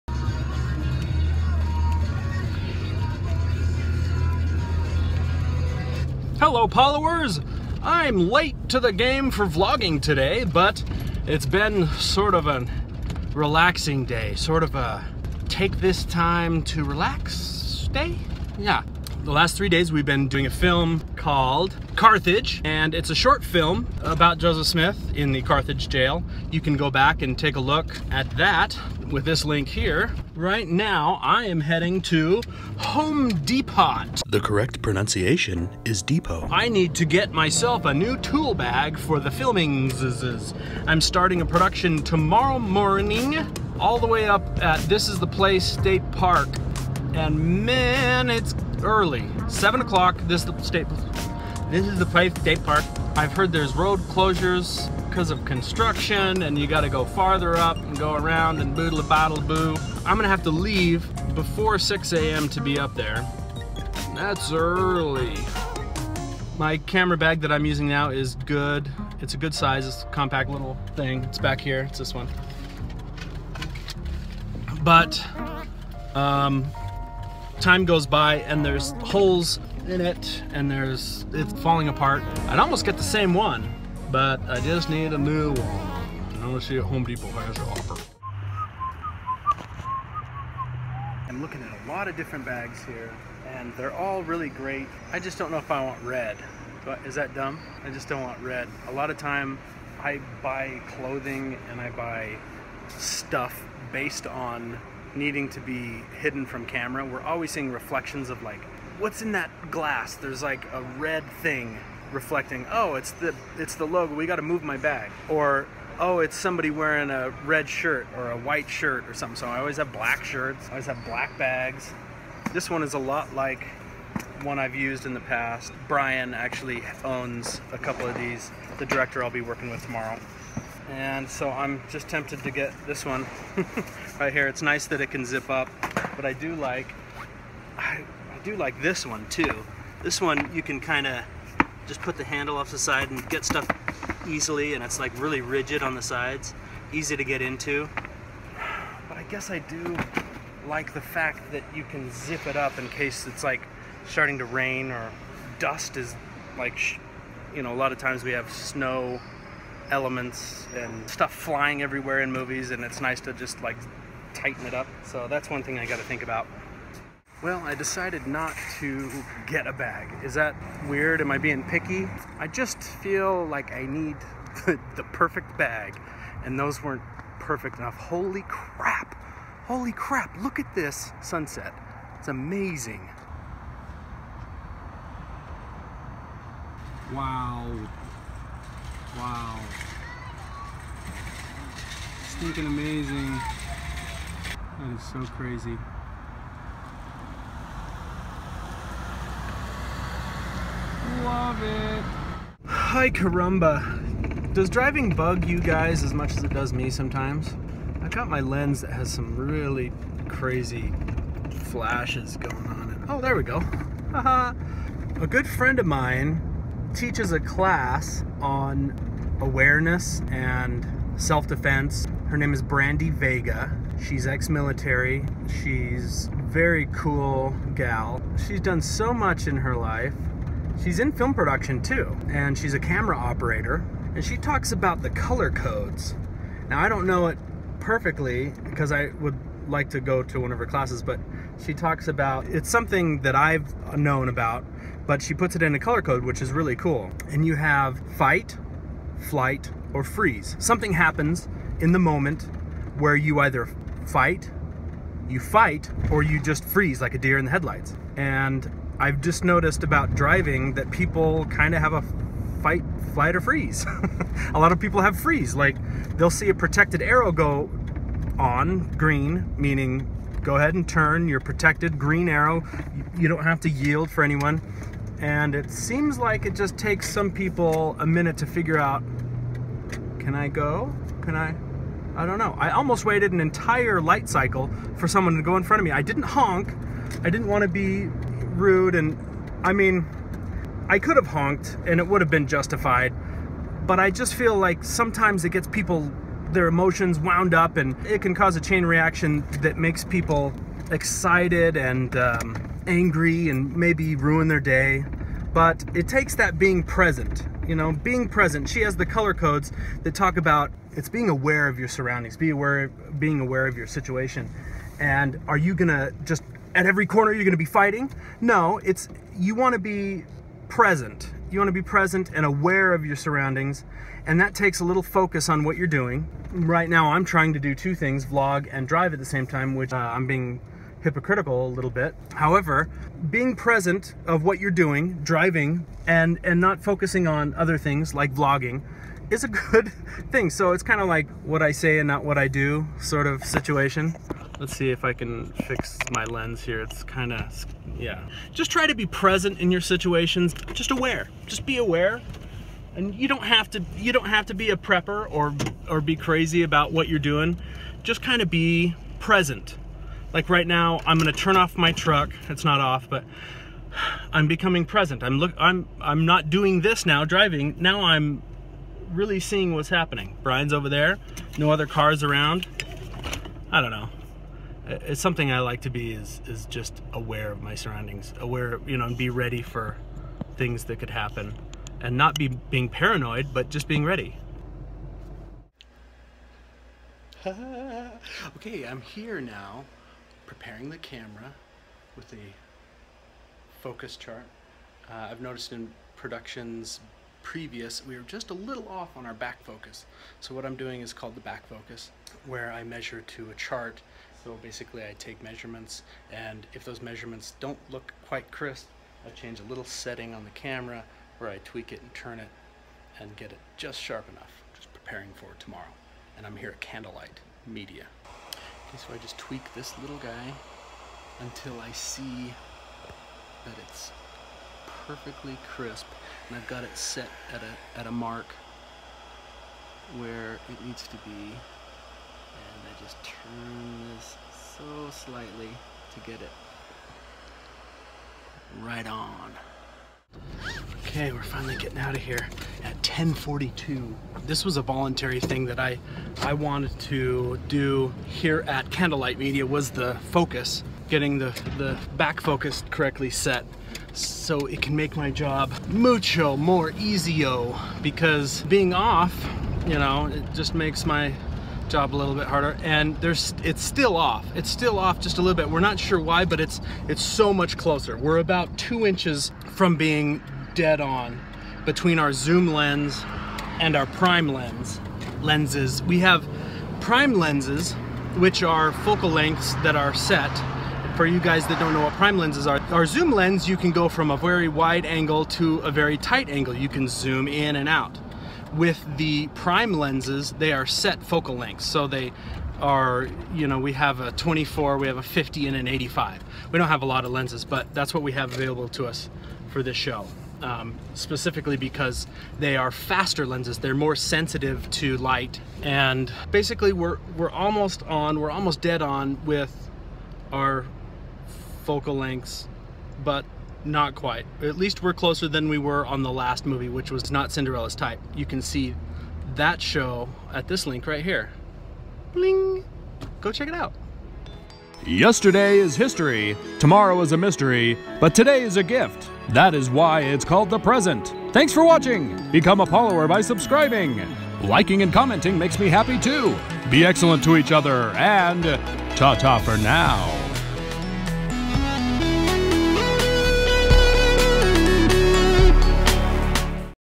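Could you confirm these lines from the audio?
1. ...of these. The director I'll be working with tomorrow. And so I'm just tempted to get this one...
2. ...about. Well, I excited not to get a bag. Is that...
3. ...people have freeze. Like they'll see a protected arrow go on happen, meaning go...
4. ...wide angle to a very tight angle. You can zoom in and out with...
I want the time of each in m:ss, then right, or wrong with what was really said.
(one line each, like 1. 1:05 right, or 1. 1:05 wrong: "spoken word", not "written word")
1. 2:08 right
2. 2:46 wrong: "decided", not "excited"
3. 4:24 wrong: "green", not "happen"
4. 8:04 right.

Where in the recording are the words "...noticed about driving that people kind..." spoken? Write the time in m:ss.
4:19.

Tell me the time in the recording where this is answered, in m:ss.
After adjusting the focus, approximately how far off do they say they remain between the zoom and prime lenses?
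7:48.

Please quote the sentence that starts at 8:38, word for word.
You can see that show at this link right here.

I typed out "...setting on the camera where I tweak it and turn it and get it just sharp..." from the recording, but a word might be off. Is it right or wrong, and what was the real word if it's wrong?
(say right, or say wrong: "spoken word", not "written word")
right.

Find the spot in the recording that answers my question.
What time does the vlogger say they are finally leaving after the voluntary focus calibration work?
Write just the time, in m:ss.
7:22.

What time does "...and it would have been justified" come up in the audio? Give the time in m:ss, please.
4:51.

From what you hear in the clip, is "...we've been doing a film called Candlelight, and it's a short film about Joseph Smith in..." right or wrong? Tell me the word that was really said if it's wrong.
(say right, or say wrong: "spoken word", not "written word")
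wrong: "Carthage", not "Candlelight".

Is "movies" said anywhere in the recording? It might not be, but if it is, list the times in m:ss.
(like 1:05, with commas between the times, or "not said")
2:42, 8:36.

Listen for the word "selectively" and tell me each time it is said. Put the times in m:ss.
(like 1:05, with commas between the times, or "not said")
not said.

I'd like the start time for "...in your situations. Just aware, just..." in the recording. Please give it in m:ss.
5:49.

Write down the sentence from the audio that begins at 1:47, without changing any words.
We're always seeing reflections of like, what's in that glass?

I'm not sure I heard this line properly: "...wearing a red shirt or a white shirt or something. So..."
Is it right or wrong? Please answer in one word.
right.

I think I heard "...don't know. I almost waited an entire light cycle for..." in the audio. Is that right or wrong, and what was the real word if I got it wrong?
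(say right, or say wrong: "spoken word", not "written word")
right.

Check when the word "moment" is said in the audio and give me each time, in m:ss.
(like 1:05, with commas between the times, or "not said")
4:11.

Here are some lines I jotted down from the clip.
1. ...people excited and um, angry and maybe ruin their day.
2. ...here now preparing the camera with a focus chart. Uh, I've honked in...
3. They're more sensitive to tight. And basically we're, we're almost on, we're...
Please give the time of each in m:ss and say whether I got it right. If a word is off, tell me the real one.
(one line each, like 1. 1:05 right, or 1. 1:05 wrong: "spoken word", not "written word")
1. 5:00 right
2. 6:29 wrong: "noticed", not "honked"
3. 8:23 wrong: "light", not "tight".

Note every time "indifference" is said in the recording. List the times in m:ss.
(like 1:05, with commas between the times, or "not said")
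not said.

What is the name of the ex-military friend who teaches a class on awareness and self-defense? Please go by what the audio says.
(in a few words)
Brandy Vega.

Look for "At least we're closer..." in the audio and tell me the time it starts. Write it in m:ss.
8:34.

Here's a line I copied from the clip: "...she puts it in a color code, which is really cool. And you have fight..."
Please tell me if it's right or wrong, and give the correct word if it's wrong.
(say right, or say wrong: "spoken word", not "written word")
right.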